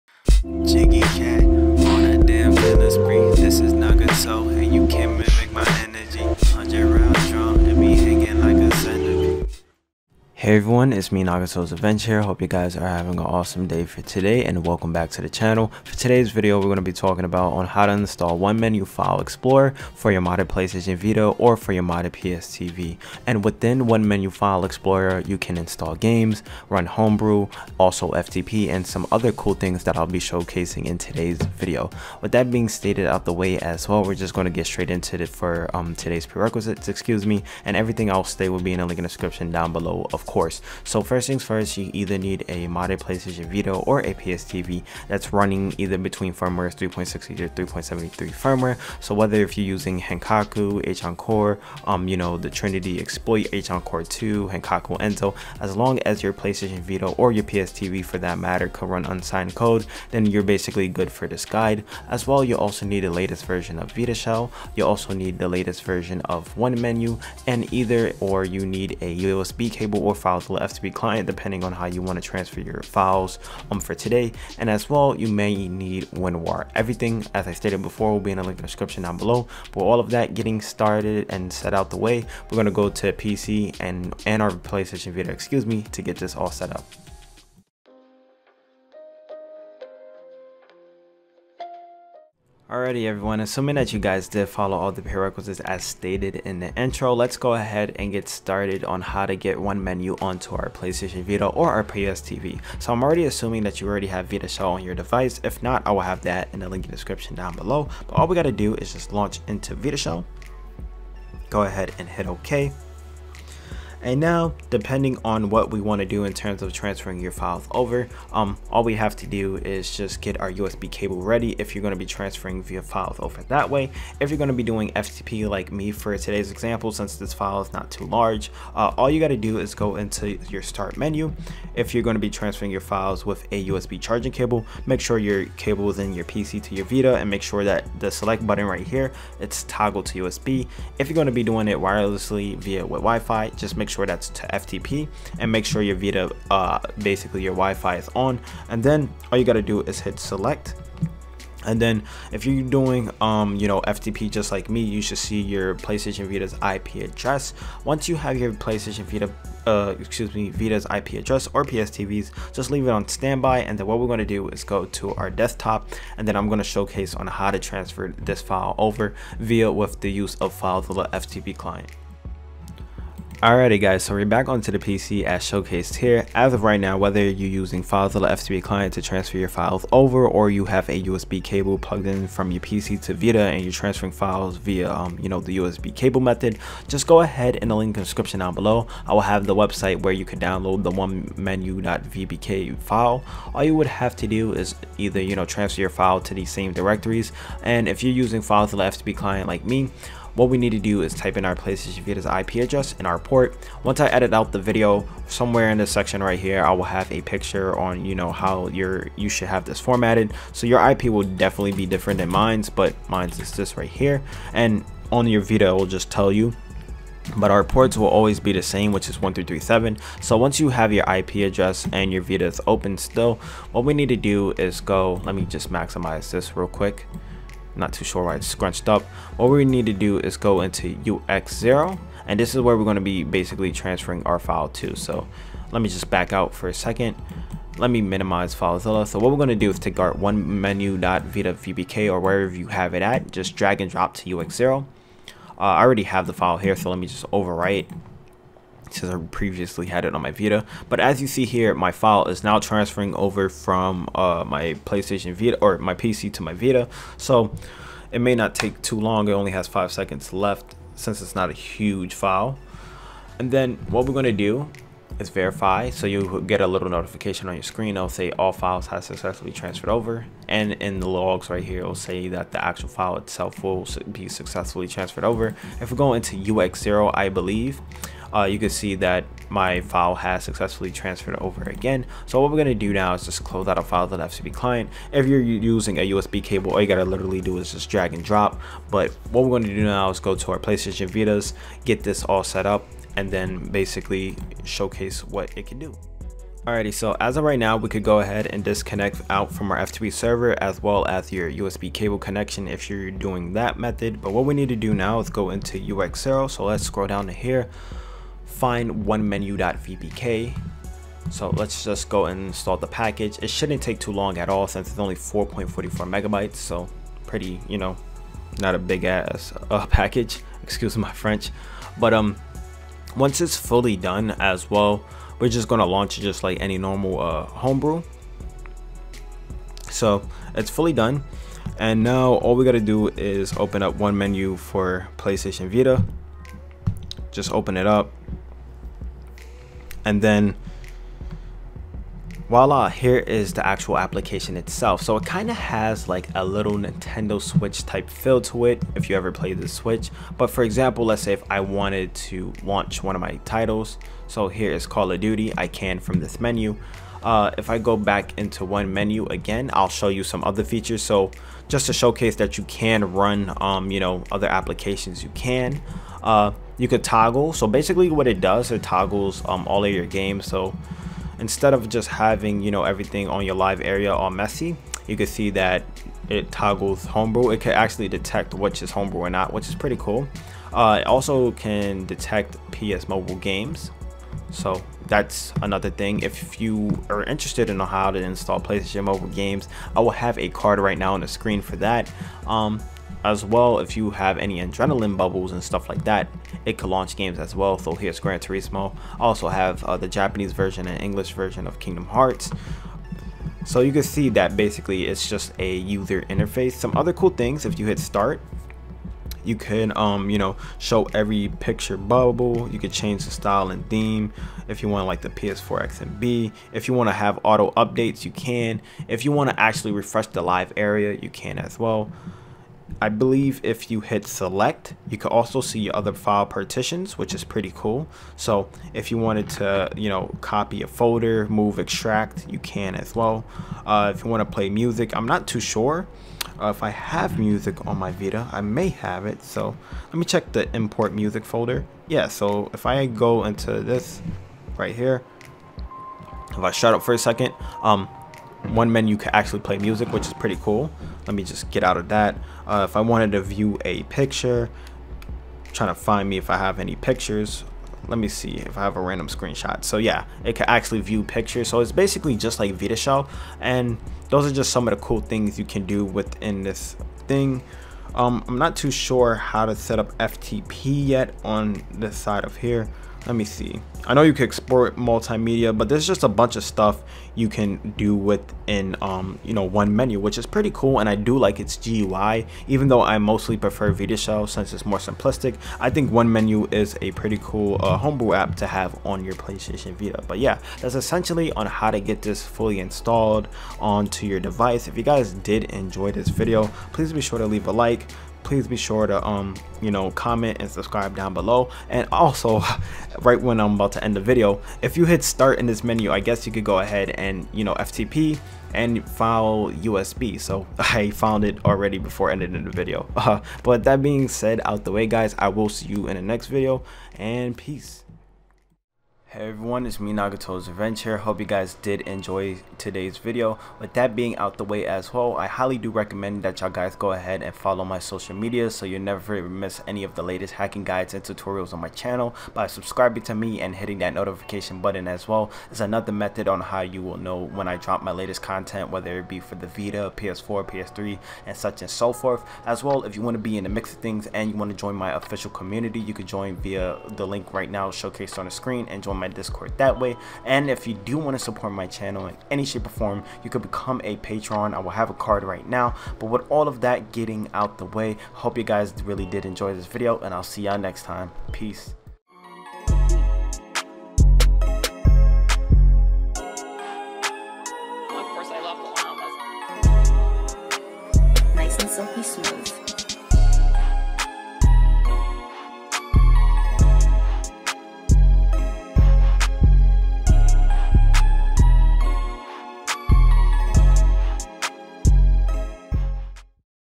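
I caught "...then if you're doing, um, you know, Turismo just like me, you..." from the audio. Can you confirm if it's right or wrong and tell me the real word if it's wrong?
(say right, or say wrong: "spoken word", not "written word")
wrong: "FTP", not "Turismo".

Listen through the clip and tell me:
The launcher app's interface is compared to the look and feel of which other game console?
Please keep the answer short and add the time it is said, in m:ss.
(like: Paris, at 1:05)
Nintendo Switch, at 5:46.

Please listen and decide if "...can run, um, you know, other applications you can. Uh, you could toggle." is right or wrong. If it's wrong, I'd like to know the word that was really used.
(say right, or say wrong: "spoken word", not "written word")
right.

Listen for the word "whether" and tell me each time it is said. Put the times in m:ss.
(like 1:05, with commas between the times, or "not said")
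0:49, 2:56, 8:58.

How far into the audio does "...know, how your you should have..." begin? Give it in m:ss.
3:28.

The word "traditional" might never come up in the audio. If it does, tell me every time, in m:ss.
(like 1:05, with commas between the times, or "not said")
not said.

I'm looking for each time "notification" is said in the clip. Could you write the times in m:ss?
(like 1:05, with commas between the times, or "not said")
4:26, 8:54.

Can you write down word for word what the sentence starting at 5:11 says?
So let's just go and install the package.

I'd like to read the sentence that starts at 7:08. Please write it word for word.
So if you wanted to, you know, copy a folder, move, extract, you can as well.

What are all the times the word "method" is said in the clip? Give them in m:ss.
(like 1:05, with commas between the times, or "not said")
3:06, 5:03, 8:56.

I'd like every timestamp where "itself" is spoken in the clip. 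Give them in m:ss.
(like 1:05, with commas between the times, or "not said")
4:33, 5:44.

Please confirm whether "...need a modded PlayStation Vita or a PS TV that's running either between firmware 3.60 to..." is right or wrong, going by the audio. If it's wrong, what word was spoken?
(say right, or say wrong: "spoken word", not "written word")
right.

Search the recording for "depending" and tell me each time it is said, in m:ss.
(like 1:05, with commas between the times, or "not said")
1:11, 1:54.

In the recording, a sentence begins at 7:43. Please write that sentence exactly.
And those are just some of the cool things you can do within this thing.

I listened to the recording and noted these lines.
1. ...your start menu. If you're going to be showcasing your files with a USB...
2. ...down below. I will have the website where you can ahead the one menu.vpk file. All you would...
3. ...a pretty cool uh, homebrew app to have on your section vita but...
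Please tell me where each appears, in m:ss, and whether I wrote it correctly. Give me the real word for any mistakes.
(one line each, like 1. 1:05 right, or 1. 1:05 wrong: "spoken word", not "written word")
1. 2:10 wrong: "transferring", not "showcasing"
2. 3:08 wrong: "download", not "ahead"
3. 8:07 wrong: "playstation", not "section".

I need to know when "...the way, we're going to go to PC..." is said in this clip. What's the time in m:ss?
1:21.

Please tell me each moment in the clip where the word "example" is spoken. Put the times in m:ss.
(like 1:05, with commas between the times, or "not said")
2:06, 5:50.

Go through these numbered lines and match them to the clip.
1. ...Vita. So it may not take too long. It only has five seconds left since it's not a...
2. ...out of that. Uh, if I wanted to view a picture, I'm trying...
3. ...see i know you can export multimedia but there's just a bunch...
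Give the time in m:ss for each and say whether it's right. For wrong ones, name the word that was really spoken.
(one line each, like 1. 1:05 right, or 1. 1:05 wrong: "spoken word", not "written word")
1. 4:16 right
2. 7:31 right
3. 7:53 right.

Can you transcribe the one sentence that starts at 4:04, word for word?
Uh, I already have the file here, so let me just overwrite since I previously had it on my Vita.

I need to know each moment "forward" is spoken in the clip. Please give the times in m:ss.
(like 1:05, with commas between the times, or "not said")
not said.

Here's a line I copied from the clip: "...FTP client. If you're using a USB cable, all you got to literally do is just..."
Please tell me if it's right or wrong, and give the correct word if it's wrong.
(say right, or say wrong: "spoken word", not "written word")
right.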